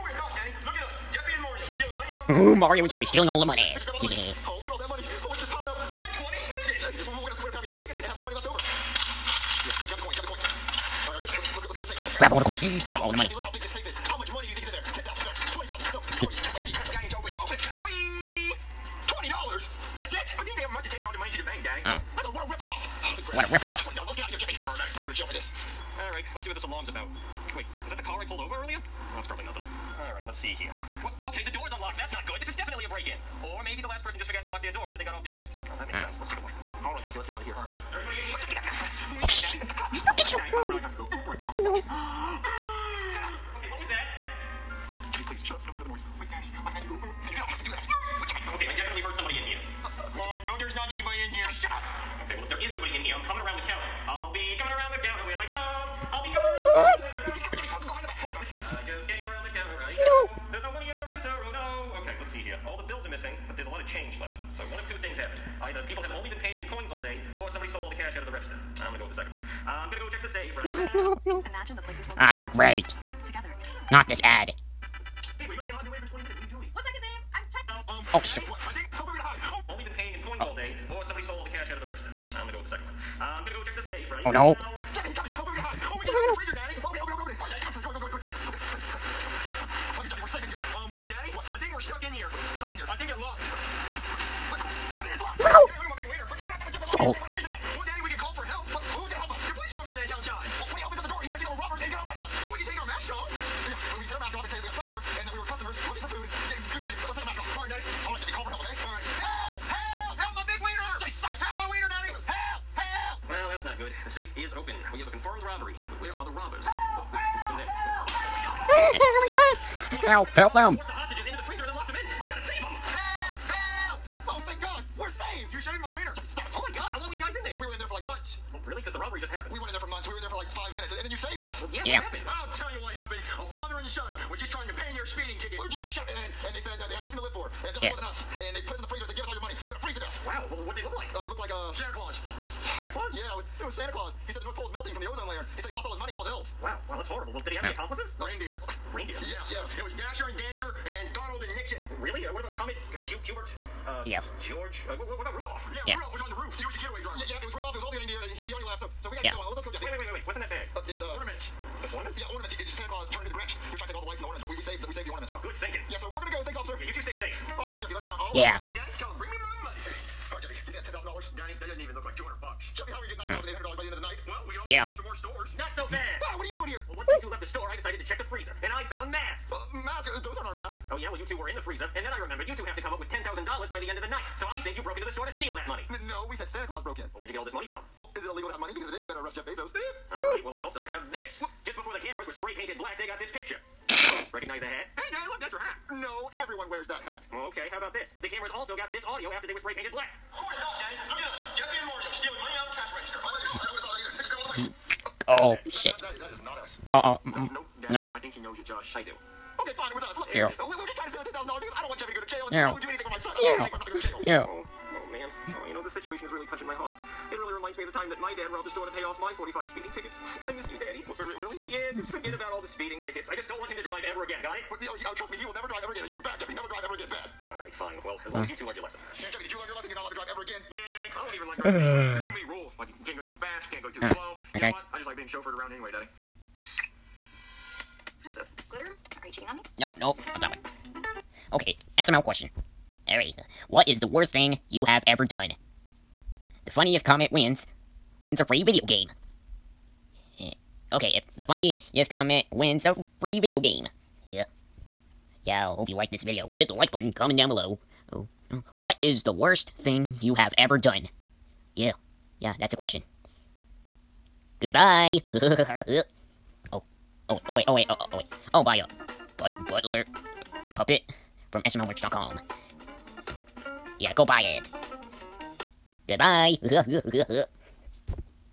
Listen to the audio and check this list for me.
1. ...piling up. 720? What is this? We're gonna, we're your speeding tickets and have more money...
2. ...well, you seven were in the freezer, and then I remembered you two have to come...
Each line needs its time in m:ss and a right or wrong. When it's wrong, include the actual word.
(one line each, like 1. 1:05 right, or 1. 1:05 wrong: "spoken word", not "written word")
1. 0:05 wrong: "120", not "720"
2. 3:01 wrong: "two", not "seven".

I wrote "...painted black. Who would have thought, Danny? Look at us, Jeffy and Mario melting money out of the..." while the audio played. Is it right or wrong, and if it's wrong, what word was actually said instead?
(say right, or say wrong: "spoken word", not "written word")
wrong: "stealing", not "melting".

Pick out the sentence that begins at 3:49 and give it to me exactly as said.
You're not allowed to drive ever again.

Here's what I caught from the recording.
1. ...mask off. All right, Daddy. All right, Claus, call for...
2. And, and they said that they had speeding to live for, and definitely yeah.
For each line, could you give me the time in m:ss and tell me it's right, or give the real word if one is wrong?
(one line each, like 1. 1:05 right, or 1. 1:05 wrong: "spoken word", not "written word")
1. 1:47 wrong: "Jeffy", not "Claus"
2. 2:16 wrong: "nothing", not "speeding".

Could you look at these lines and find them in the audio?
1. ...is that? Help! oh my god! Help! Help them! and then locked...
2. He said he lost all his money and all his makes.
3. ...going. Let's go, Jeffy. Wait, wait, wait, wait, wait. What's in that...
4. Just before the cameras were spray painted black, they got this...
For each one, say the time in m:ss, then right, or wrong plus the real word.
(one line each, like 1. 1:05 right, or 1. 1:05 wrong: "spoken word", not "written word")
1. 1:57 right
2. 2:25 wrong: "elves", not "makes"
3. 2:39 right
4. 3:11 right.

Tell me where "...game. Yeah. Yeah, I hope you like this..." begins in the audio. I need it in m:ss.
4:13.